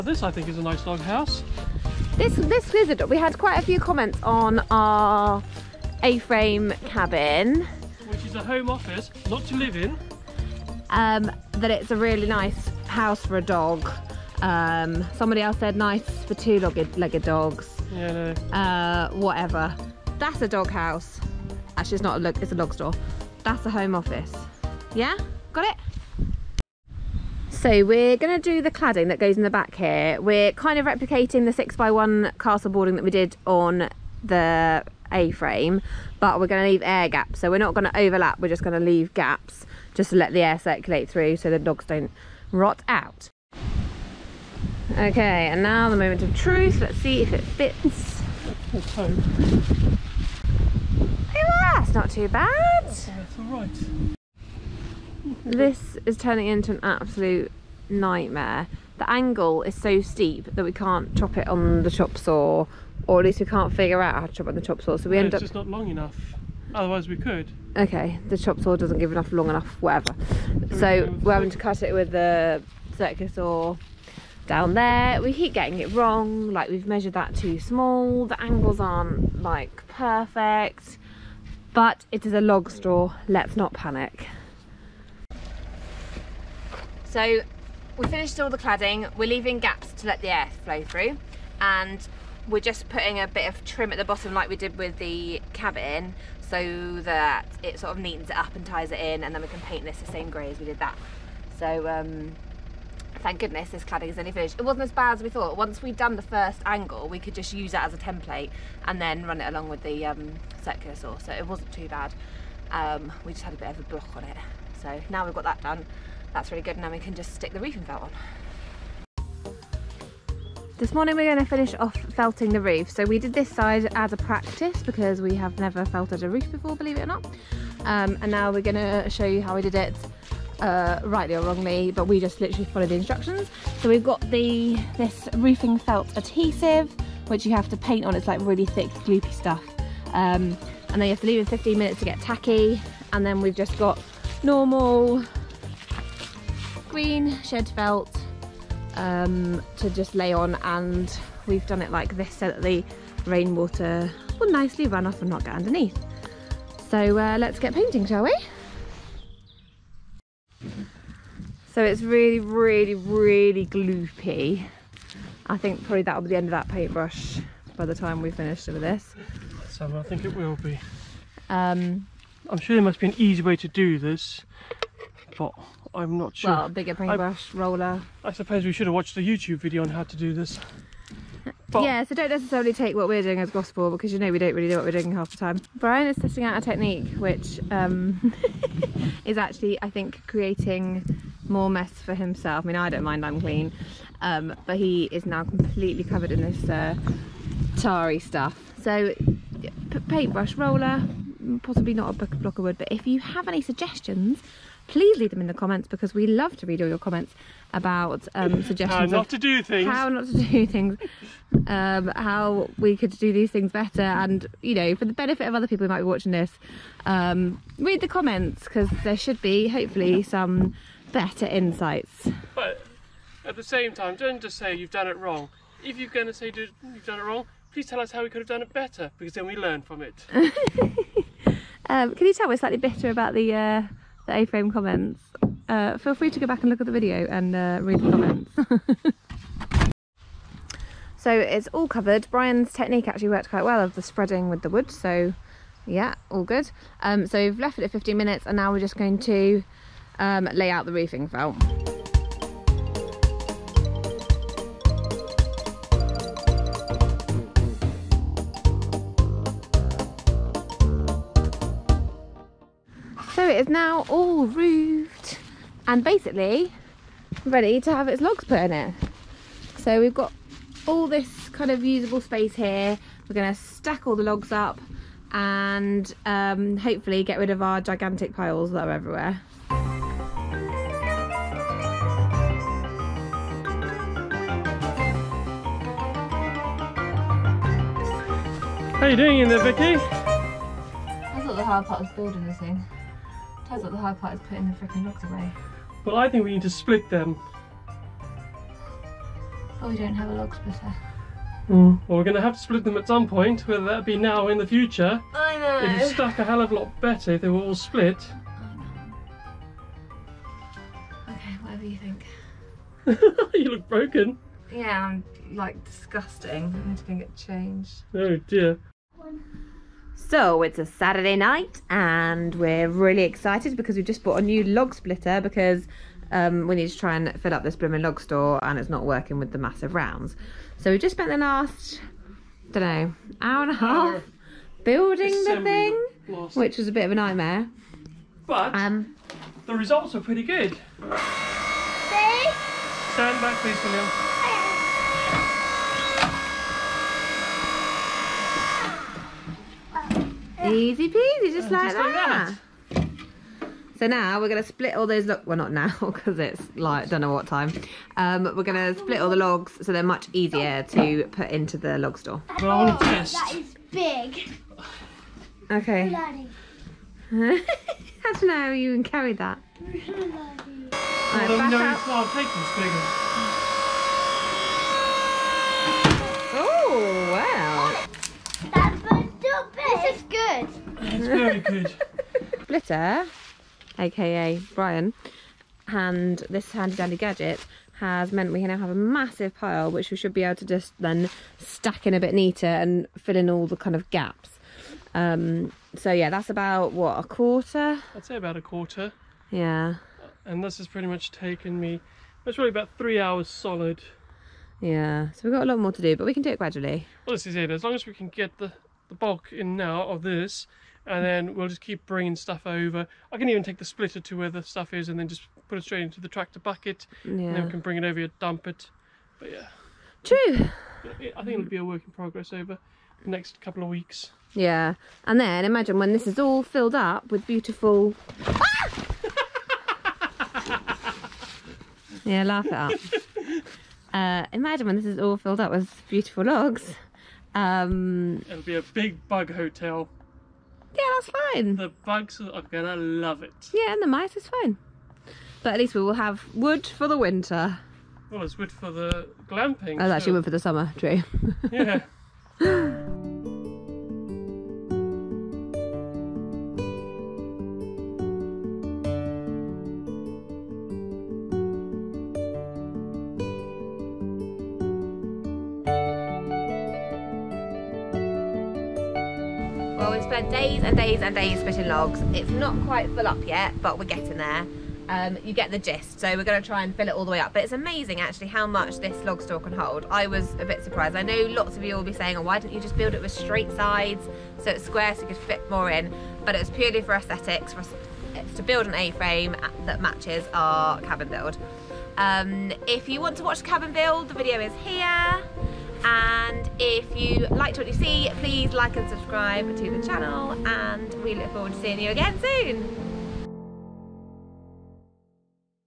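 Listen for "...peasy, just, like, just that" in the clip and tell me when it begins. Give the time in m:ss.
5:51.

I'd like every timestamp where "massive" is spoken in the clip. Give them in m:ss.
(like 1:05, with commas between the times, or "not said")
5:29, 6:28.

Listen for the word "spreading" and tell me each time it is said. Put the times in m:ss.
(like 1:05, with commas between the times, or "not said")
4:04.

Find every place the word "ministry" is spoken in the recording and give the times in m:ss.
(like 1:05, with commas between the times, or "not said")
not said.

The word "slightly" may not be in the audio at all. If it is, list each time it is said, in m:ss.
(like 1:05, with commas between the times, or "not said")
3:52.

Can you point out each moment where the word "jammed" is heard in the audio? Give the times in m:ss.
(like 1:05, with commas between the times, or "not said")
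not said.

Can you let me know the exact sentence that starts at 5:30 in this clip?
So we just spent the last, I don't know, hour and a half hour.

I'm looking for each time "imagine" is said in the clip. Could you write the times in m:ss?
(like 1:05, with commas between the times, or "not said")
7:05, 7:14.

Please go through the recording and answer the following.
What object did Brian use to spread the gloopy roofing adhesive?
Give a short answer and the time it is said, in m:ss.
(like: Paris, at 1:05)
block of wood, at 3:22.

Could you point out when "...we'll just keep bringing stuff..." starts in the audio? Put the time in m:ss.
6:51.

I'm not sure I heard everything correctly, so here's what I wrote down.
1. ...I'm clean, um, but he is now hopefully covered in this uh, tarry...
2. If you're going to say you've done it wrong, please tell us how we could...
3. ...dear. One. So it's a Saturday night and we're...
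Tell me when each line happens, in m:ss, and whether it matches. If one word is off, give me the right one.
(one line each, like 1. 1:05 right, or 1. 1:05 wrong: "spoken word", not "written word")
1. 3:13 wrong: "completely", not "hopefully"
2. 3:45 right
3. 5:18 right.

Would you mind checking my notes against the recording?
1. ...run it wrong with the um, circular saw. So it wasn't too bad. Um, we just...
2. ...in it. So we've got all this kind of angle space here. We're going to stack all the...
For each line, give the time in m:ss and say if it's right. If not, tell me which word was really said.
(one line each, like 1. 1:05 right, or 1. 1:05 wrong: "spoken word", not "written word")
1. 1:49 wrong: "along", not "wrong"
2. 4:28 wrong: "usable", not "angle".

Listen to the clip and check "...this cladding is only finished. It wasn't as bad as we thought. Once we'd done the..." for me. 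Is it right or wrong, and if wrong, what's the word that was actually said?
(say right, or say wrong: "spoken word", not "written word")
right.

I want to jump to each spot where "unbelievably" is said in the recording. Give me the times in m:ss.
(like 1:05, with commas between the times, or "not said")
not said.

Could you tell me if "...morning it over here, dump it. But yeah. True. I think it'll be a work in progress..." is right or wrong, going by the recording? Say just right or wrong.
wrong.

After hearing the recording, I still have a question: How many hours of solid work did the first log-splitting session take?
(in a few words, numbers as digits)
3.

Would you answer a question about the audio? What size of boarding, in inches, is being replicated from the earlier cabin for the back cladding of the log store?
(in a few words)
6x1.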